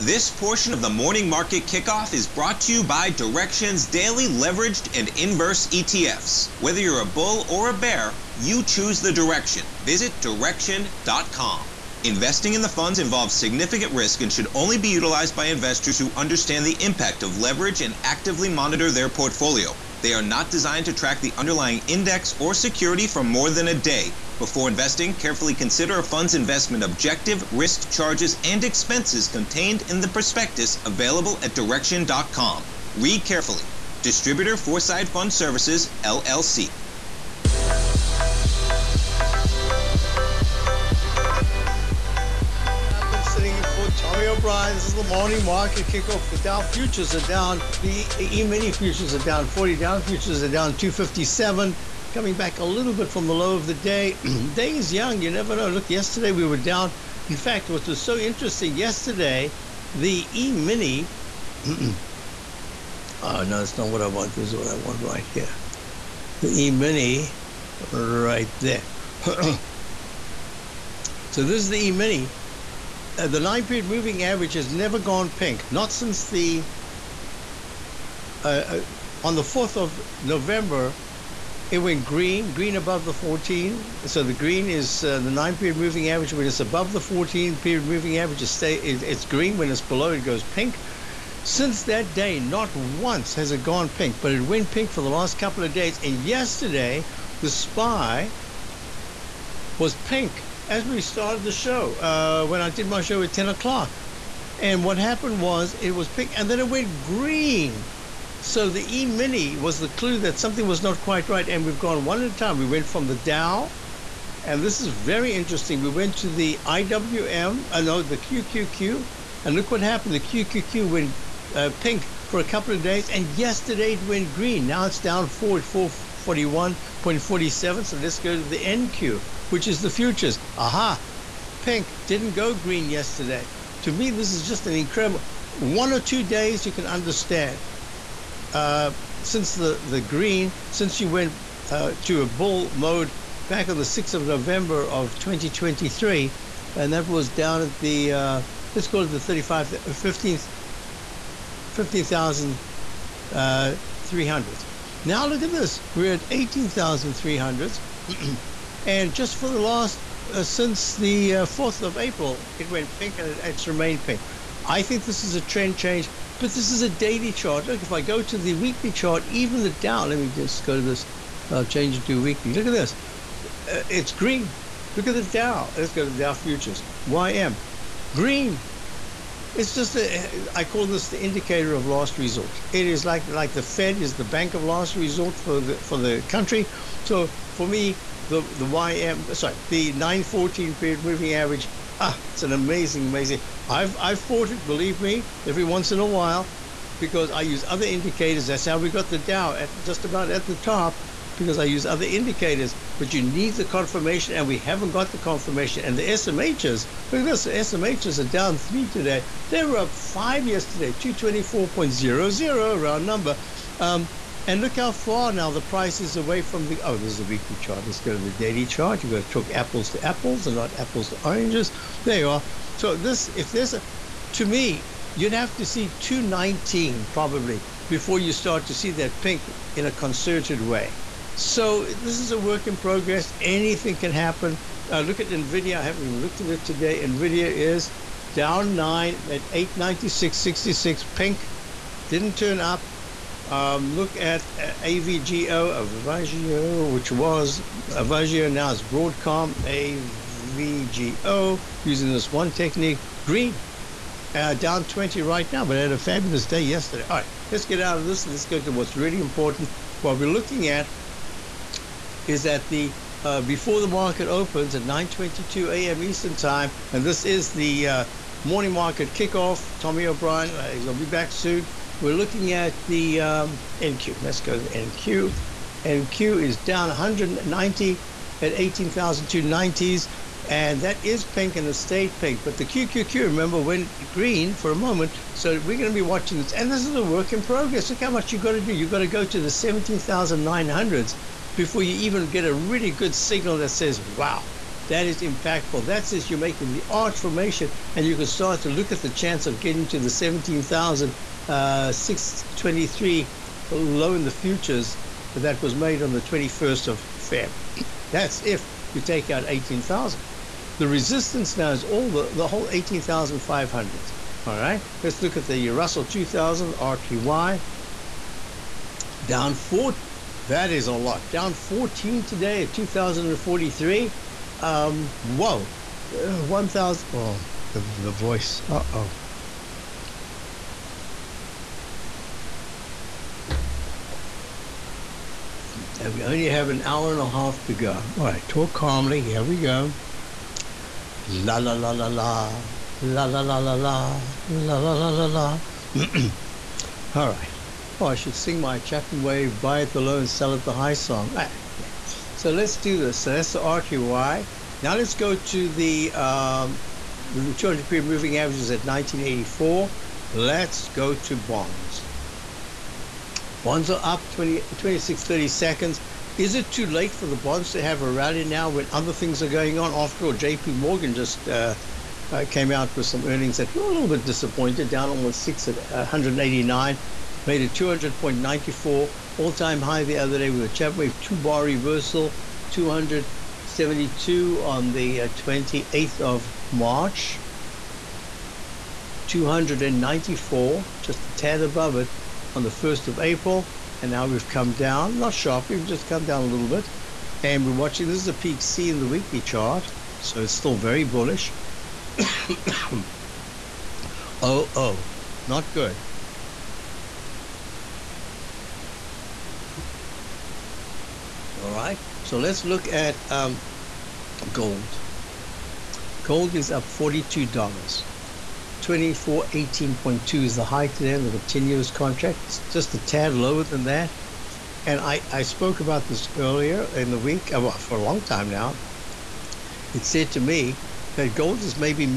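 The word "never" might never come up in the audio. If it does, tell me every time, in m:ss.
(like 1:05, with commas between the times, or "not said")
0:55, 1:14.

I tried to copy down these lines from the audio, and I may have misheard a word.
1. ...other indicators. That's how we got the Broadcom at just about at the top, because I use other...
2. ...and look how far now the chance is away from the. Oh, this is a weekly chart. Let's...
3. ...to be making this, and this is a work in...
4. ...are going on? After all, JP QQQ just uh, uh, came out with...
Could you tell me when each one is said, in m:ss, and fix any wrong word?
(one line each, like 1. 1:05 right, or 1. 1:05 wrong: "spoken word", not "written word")
1. 3:17 wrong: "Dow", not "Broadcom"
2. 3:34 wrong: "price", not "chance"
3. 4:45 wrong: "watching", not "making"
4. 6:09 wrong: "Morgan", not "QQQ".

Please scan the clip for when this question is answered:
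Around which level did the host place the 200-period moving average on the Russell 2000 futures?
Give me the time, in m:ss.
5:58.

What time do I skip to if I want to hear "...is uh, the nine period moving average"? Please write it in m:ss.
1:24.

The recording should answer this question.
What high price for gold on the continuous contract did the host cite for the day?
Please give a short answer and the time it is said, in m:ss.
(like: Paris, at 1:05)
2418.2, at 6:58.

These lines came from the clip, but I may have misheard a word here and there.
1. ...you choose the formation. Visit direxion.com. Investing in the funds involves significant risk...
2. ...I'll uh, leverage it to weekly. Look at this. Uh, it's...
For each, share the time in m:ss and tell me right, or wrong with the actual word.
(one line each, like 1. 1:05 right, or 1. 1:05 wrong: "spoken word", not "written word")
1. 0:08 wrong: "direction", not "formation"
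2. 2:51 wrong: "change", not "leverage".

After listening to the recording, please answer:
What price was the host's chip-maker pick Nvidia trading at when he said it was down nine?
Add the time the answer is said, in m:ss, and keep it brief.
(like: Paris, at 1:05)
896.66, at 3:59.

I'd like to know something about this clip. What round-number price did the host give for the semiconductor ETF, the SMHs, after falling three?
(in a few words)
224.00.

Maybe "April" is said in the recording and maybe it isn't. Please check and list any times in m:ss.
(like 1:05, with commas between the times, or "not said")
2:41, 6:33.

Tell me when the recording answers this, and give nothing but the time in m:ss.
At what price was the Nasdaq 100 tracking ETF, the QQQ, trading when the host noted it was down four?
2:05.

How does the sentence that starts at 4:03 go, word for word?
Um, look at uh, AVGO, Avago, which was Avago, now it's Broadcom, AVGO, using this one technique, green.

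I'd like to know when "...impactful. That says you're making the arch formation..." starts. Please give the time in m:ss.
4:55.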